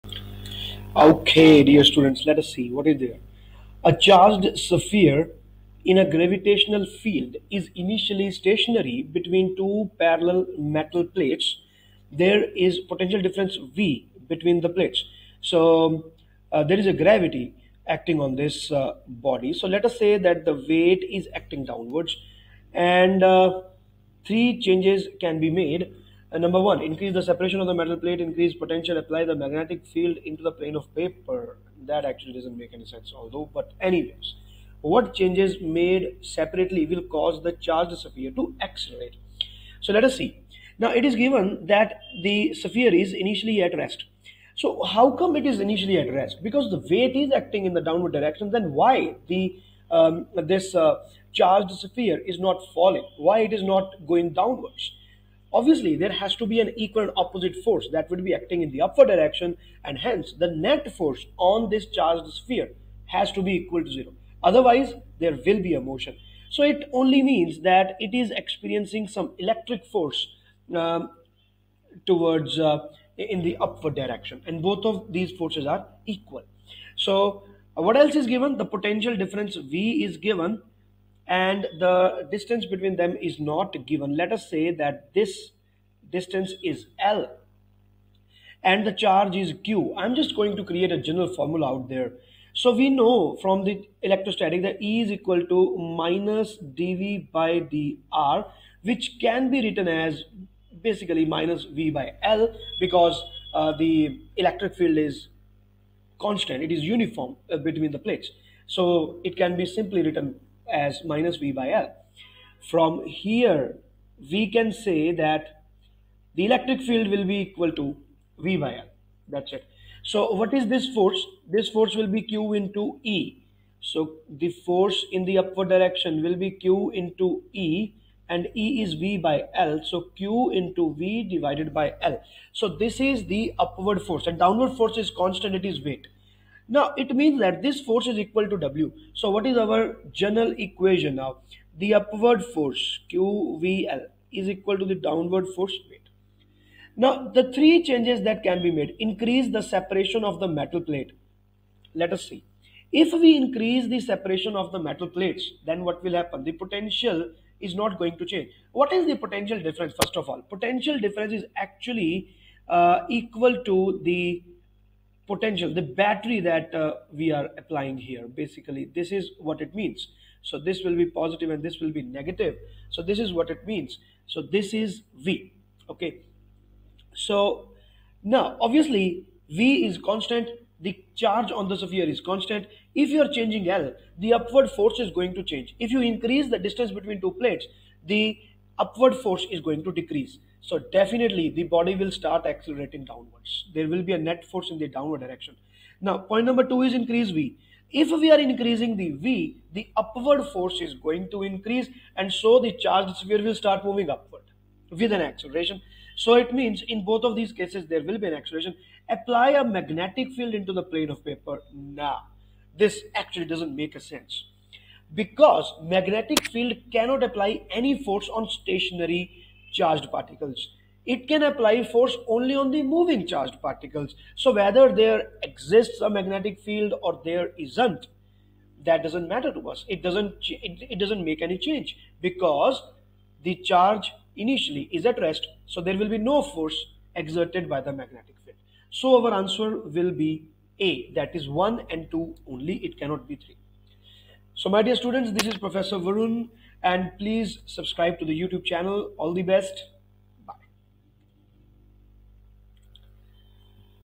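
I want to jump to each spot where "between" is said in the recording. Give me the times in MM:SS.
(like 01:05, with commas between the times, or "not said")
00:09, 00:14, 01:22, 01:47, 03:06.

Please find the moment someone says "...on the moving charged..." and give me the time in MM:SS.
03:42.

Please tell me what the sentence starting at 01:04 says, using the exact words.
Otherwise, there will be a motion.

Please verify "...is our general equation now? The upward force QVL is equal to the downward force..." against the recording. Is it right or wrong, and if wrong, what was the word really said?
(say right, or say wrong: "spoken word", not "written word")
right.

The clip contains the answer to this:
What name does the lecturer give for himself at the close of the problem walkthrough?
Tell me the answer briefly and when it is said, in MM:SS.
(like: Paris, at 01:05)
Professor Varun, at 04:05.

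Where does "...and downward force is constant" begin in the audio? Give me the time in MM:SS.
02:14.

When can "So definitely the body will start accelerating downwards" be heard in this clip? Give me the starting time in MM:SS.
03:10.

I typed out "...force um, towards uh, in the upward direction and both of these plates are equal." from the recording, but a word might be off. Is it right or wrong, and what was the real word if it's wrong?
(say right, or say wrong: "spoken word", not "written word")
wrong: "forces", not "plates".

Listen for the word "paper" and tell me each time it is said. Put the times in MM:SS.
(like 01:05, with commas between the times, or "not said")
00:30, 03:31.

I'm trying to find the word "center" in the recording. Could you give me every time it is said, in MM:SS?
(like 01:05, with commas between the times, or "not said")
not said.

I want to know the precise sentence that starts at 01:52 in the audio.
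From here, we can say that the electric field will be equal to V by L.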